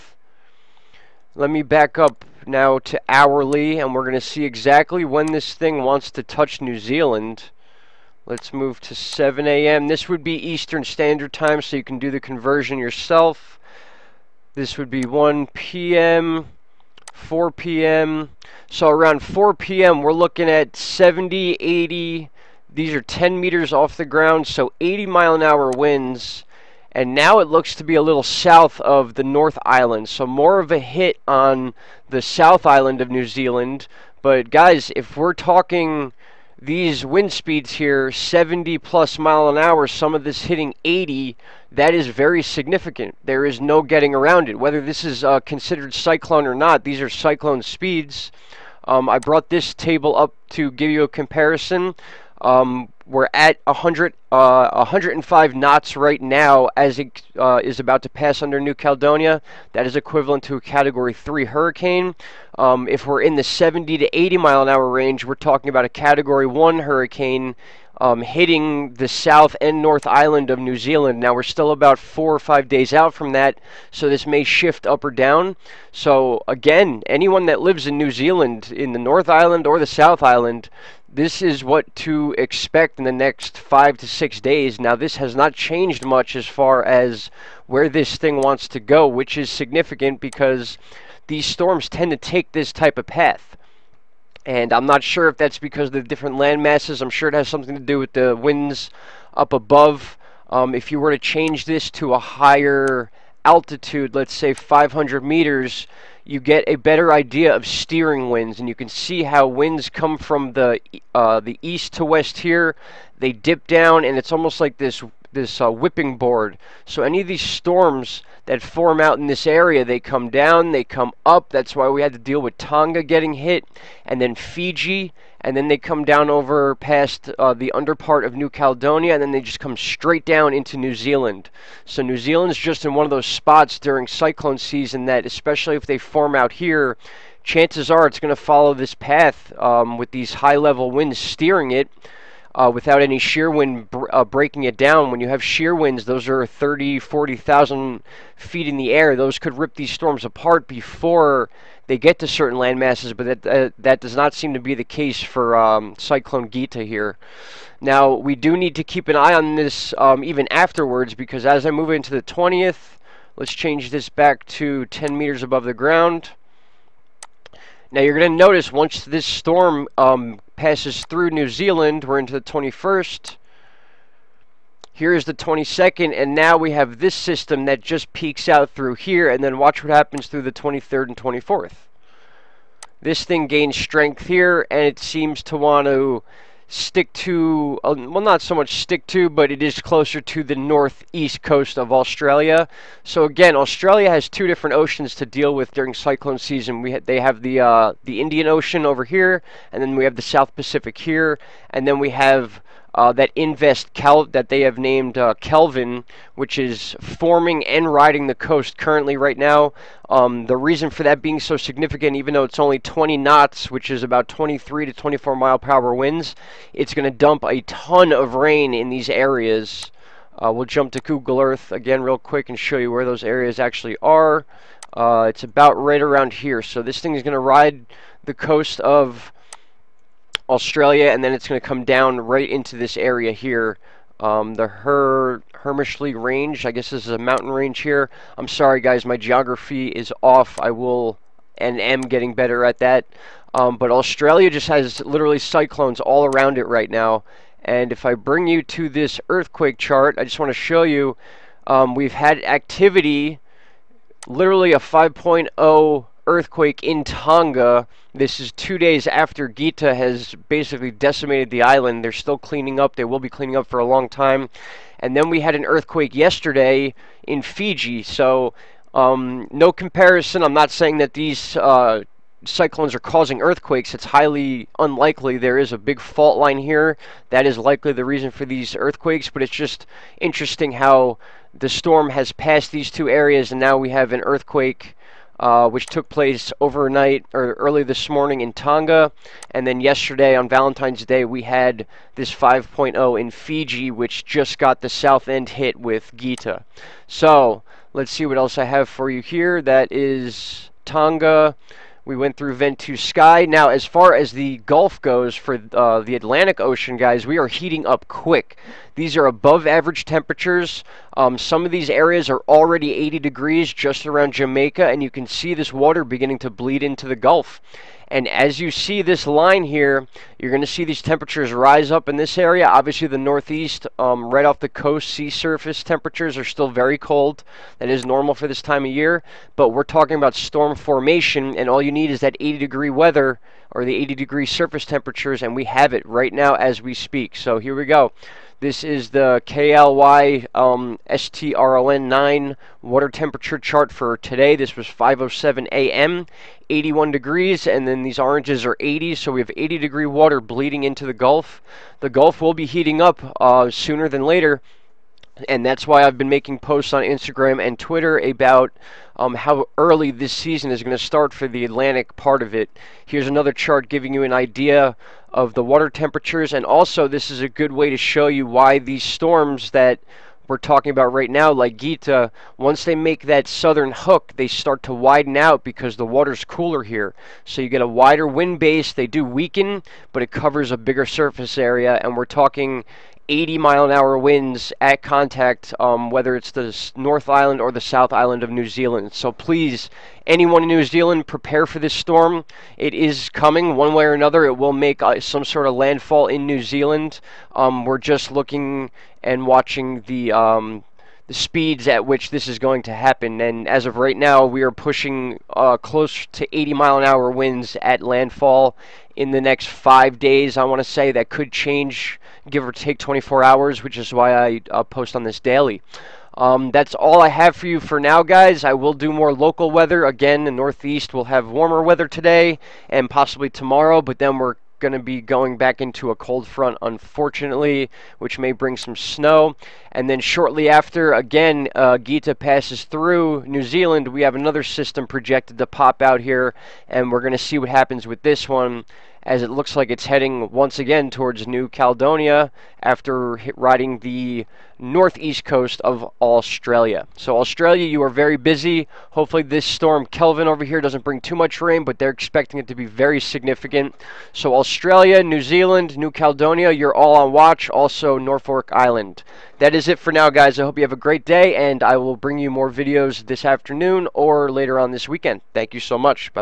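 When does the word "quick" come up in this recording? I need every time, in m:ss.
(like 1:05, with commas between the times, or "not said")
3:42, 5:08.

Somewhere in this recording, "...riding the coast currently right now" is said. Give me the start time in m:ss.
3:27.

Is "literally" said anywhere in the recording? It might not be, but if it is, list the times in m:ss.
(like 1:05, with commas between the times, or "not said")
4:05, 4:14.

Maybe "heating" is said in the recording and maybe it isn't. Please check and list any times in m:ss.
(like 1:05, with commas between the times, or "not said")
5:07, 5:52.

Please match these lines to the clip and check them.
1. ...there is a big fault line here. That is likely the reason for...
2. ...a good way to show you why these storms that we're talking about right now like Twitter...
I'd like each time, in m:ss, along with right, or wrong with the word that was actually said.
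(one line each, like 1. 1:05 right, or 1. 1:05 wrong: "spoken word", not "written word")
1. 4:35 right
2. 6:07 wrong: "Gita", not "Twitter".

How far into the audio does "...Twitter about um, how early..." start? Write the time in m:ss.
5:57.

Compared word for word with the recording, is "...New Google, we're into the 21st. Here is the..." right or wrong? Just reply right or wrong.
wrong.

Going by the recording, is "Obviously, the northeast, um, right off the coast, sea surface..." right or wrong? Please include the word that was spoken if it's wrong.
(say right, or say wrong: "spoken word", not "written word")
right.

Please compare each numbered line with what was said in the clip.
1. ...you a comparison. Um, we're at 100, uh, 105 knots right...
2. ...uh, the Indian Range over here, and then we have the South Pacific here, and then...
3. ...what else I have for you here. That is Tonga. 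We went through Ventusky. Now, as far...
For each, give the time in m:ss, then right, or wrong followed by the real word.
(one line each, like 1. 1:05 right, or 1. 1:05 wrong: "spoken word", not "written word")
1. 0:50 right
2. 3:17 wrong: "Ocean", not "Range"
3. 4:58 right.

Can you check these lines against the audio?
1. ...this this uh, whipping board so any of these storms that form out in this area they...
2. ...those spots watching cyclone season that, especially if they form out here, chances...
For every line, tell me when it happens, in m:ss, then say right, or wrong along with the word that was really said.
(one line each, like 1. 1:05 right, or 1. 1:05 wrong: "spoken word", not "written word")
1. 1:54 right
2. 2:13 wrong: "during", not "watching".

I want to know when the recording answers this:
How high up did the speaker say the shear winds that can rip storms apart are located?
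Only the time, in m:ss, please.
2:26.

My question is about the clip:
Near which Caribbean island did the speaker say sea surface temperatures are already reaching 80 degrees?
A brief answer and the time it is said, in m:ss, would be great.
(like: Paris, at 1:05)
Jamaica, at 5:14.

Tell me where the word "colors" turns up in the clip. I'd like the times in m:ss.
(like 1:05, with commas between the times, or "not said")
not said.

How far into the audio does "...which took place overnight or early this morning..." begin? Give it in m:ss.
4:45.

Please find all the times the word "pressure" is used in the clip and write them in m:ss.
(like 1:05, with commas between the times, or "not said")
not said.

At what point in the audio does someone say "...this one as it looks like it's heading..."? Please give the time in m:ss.
7:18.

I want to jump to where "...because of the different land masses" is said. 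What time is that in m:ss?
1:35.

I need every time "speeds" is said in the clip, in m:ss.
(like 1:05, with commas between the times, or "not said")
0:37, 0:47, 6:41.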